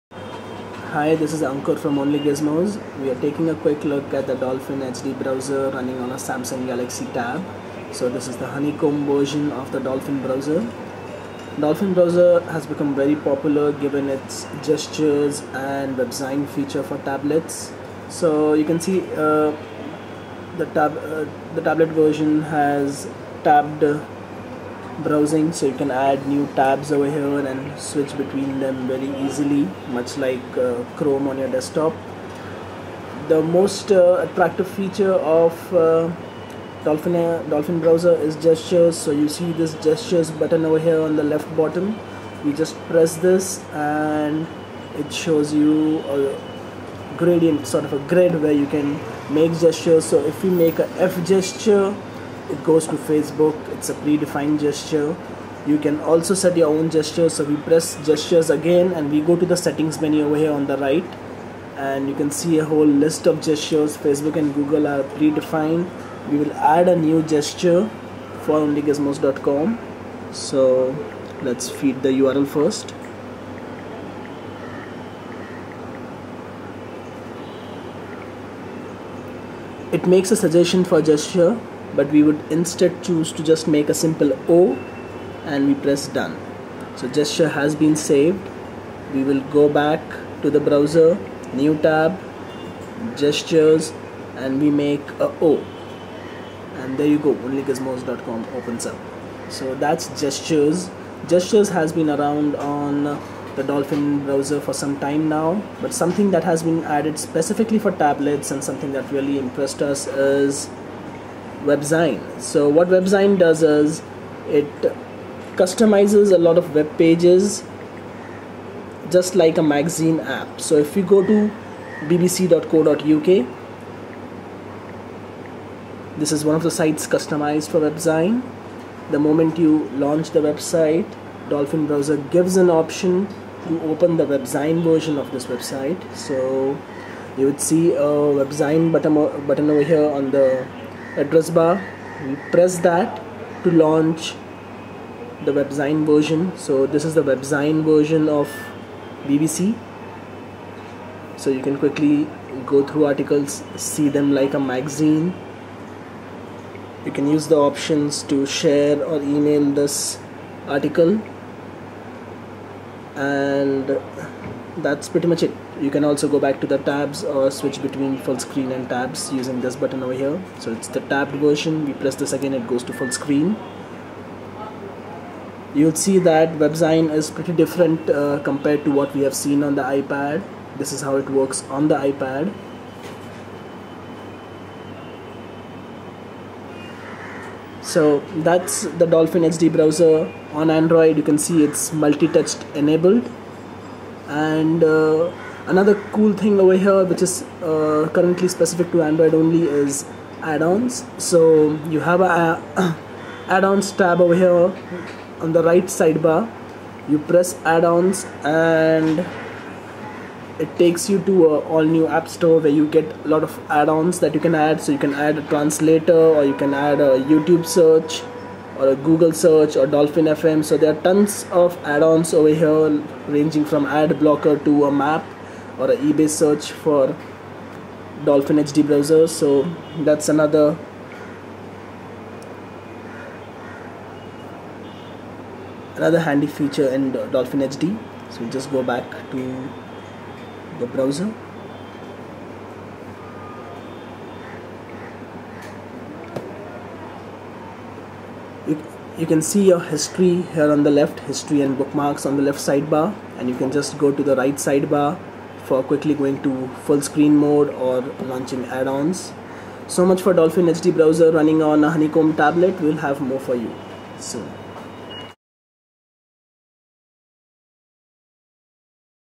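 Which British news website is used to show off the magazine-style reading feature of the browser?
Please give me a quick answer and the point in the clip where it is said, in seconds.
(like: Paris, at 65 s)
bbc.co.uk, at 122 s.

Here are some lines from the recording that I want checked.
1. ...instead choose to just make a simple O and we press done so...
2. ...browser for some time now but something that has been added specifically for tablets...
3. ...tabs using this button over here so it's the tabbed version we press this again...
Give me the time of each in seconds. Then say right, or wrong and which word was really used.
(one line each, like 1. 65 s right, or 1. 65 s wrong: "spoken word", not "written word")
1. 82 s right
2. 104 s right
3. 168 s right.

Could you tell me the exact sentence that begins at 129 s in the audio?
The moment you launch the website, Dolphin browser gives an option to open the WebZine version of this website.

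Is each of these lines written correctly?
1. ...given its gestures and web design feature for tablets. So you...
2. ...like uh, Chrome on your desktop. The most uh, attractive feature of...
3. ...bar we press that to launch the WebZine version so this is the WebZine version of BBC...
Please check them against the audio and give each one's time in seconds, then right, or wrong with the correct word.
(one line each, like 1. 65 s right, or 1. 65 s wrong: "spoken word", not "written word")
1. 13 s right
2. 30 s right
3. 141 s right.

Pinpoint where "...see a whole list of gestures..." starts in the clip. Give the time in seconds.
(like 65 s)
62 s.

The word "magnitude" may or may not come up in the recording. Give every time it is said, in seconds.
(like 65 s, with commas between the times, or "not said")
not said.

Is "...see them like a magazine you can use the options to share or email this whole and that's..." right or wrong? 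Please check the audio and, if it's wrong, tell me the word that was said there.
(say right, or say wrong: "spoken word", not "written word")
wrong: "article", not "whole".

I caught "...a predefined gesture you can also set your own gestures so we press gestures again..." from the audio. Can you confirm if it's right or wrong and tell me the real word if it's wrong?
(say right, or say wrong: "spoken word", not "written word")
right.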